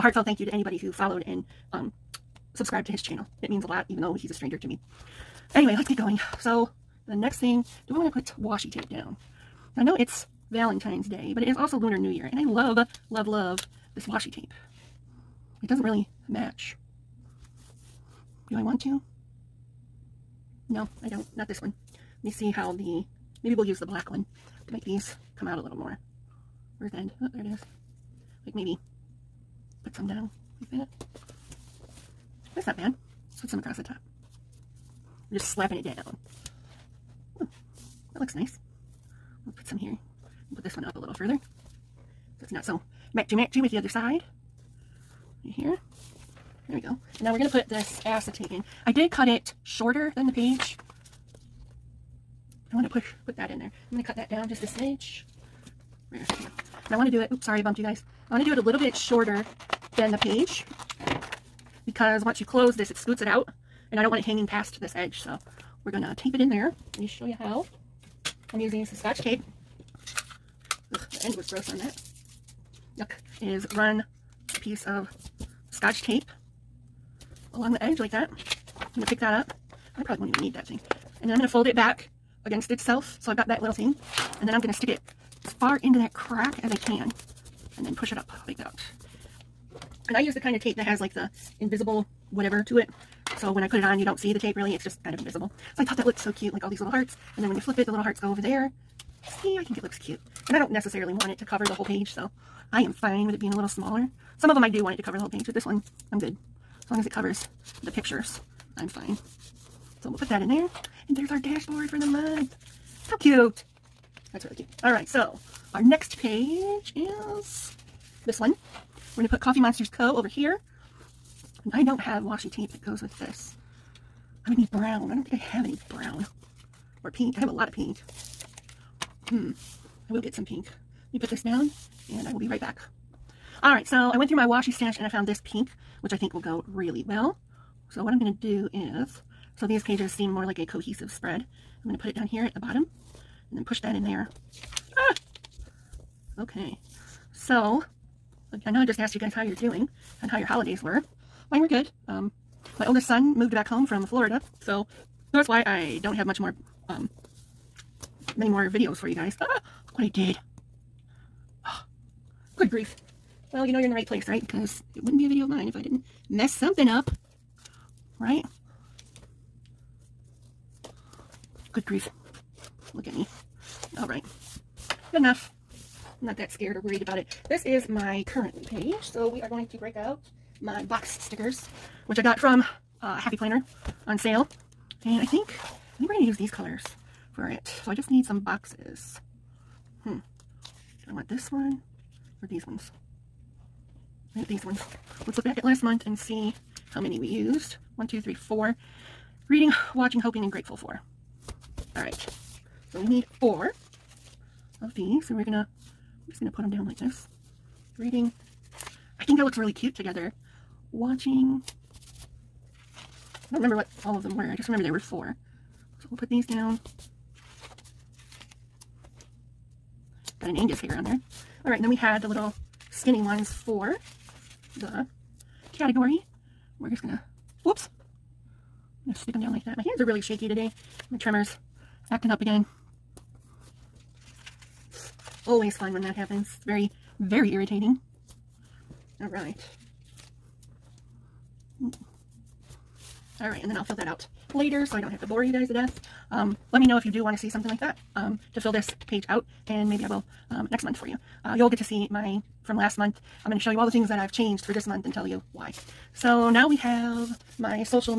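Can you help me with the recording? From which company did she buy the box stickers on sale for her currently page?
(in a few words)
Happy Planner.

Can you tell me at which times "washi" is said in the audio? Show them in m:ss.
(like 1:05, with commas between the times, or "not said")
0:08, 0:14, 2:02, 2:14.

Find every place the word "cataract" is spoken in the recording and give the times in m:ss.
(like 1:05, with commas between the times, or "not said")
not said.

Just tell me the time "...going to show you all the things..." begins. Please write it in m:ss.
4:13.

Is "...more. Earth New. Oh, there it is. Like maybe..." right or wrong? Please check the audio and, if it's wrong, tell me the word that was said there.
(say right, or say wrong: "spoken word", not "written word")
wrong: "End", not "New".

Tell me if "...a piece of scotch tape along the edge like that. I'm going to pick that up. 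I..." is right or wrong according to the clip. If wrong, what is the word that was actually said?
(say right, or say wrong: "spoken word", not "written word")
right.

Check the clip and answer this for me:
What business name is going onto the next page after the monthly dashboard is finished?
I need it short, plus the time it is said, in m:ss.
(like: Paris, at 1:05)
Coffee Monsters Co., at 1:59.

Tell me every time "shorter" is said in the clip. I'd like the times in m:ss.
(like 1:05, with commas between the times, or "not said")
0:49, 0:58.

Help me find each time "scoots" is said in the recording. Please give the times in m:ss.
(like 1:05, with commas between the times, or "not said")
1:02.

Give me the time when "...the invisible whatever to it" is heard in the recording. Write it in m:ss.
1:31.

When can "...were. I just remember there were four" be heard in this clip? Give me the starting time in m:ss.
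3:34.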